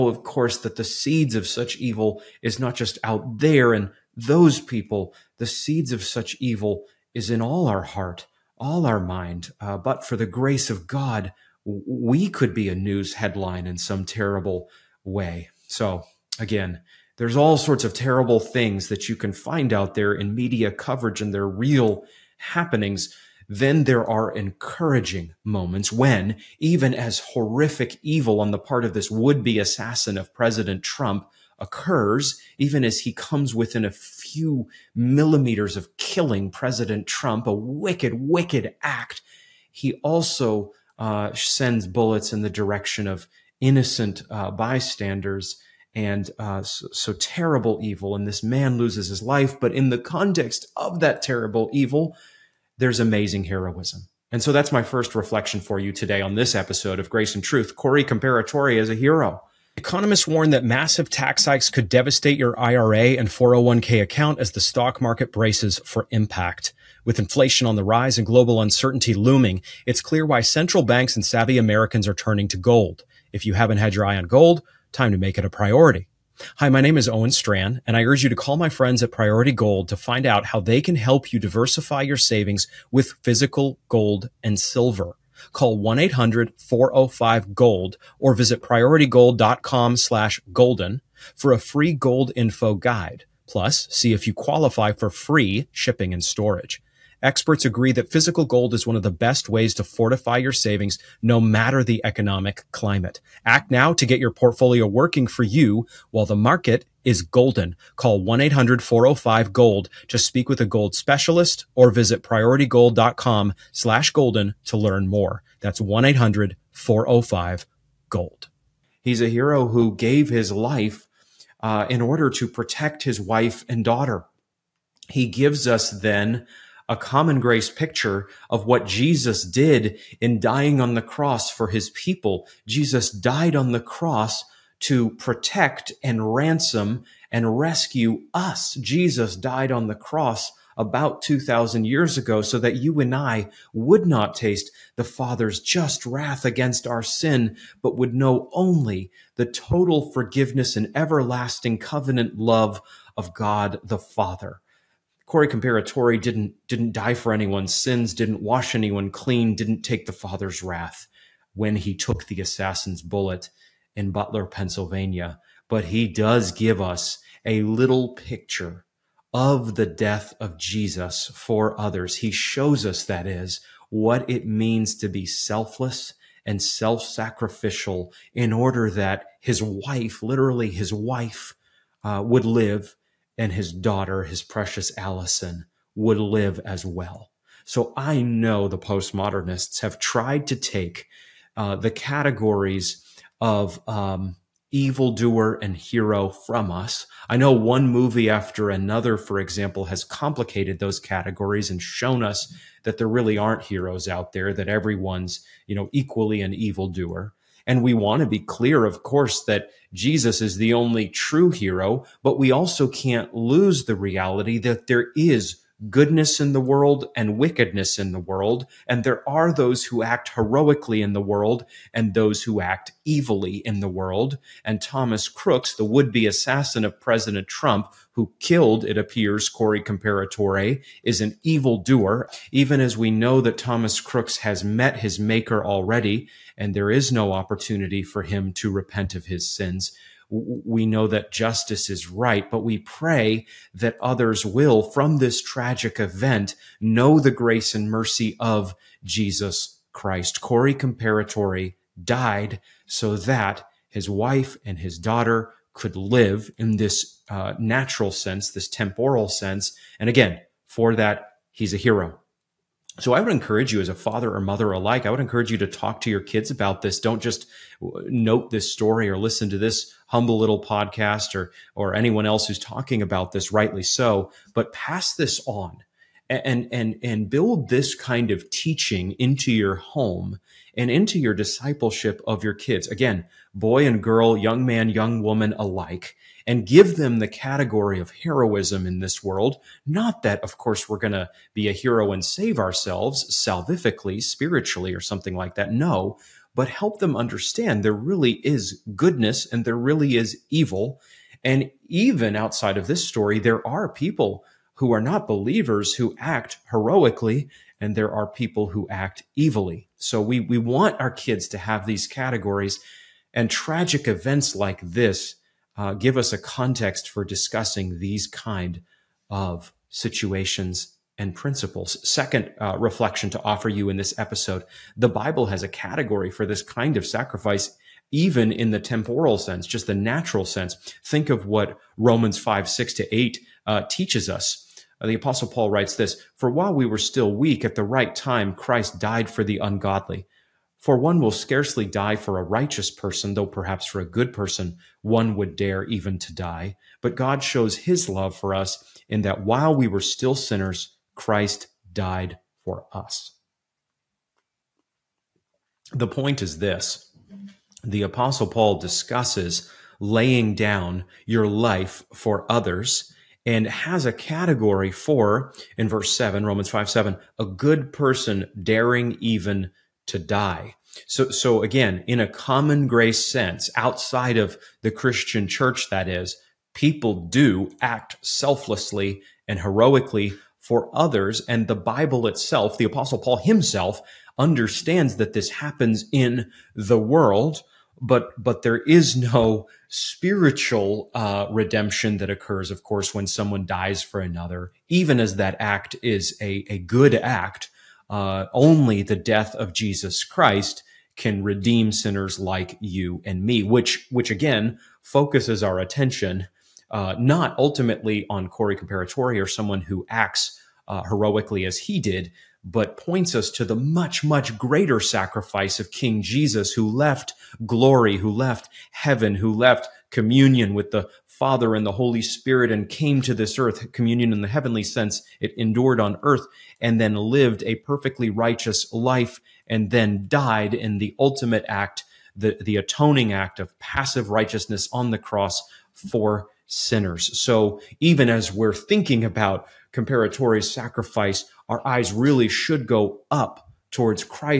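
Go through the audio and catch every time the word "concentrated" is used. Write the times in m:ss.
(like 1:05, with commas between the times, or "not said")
not said.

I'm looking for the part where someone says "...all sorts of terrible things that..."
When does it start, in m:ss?
0:17.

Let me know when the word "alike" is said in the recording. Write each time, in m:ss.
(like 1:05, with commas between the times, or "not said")
4:24, 4:45.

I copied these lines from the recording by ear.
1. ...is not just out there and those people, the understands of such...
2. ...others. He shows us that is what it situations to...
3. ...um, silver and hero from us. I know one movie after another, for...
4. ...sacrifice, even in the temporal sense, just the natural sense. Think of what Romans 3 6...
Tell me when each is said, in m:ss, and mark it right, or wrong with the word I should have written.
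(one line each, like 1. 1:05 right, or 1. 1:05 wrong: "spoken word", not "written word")
1. 0:02 wrong: "seeds", not "understands"
2. 2:51 wrong: "means", not "situations"
3. 3:13 wrong: "evildoer", not "silver"
4. 5:27 wrong: "5", not "3".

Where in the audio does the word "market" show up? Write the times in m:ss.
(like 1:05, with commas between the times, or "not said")
1:05, 1:46.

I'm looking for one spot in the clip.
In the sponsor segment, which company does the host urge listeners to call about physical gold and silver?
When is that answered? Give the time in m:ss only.
1:19.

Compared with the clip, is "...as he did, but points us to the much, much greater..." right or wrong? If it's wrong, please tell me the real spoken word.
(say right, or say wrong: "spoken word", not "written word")
right.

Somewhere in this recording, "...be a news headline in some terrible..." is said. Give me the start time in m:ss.
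0:12.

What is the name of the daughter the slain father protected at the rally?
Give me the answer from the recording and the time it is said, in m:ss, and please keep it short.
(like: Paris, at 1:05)
Allison, at 3:04.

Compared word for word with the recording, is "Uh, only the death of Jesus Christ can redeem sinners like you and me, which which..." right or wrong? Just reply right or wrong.
right.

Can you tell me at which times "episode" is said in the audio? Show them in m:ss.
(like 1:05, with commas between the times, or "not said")
0:56, 5:24.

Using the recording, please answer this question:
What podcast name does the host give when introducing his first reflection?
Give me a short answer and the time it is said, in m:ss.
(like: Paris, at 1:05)
Grace and Truth, at 0:57.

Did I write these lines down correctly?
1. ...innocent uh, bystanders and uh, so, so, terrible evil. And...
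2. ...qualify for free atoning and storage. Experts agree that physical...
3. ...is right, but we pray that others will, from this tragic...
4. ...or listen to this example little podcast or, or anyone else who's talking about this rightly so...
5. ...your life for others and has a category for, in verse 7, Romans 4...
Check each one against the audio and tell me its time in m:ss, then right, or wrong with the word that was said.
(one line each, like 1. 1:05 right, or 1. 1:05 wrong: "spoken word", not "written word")
1. 0:43 right
2. 1:34 wrong: "shipping", not "atoning"
3. 4:01 right
4. 4:29 wrong: "humble", not "example"
5. 6:01 wrong: "5", not "4".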